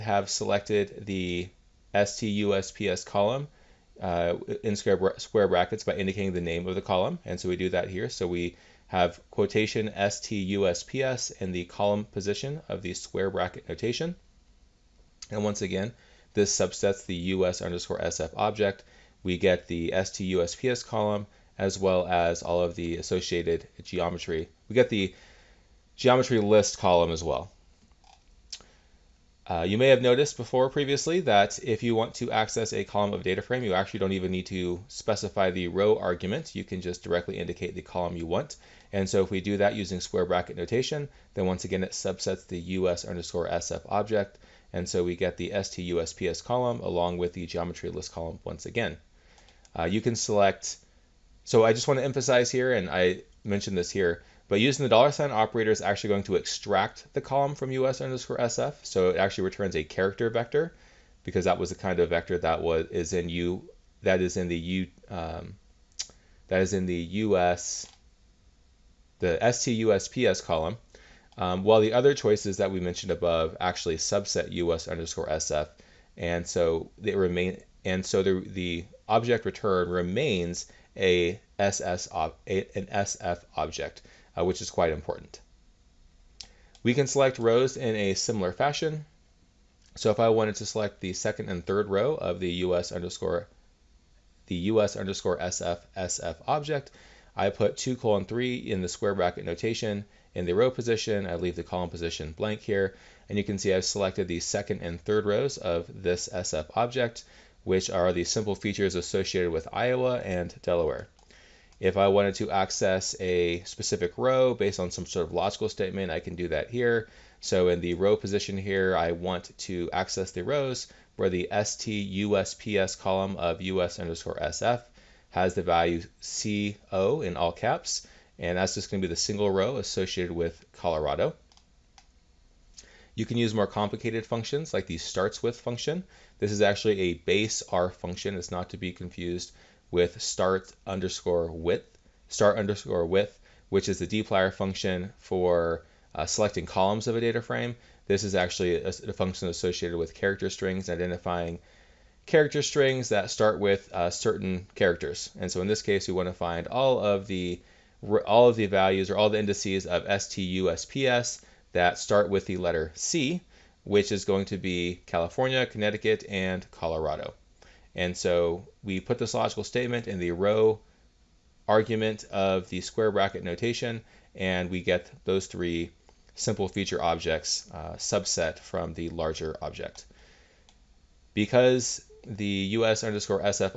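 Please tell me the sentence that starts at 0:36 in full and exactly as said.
You can just directly indicate the column you want.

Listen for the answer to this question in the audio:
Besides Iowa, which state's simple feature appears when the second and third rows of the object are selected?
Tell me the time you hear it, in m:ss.
1:50.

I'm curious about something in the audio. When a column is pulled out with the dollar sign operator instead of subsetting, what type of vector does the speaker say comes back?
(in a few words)
character vector.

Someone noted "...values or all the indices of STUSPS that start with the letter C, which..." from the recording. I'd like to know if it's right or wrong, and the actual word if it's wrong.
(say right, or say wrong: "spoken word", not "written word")
right.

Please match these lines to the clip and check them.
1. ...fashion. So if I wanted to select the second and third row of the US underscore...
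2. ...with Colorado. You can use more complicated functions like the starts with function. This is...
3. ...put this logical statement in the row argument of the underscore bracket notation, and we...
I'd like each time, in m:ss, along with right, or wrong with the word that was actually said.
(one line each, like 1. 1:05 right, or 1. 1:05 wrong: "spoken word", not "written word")
1. 1:28 right
2. 2:10 right
3. 2:49 wrong: "square", not "underscore".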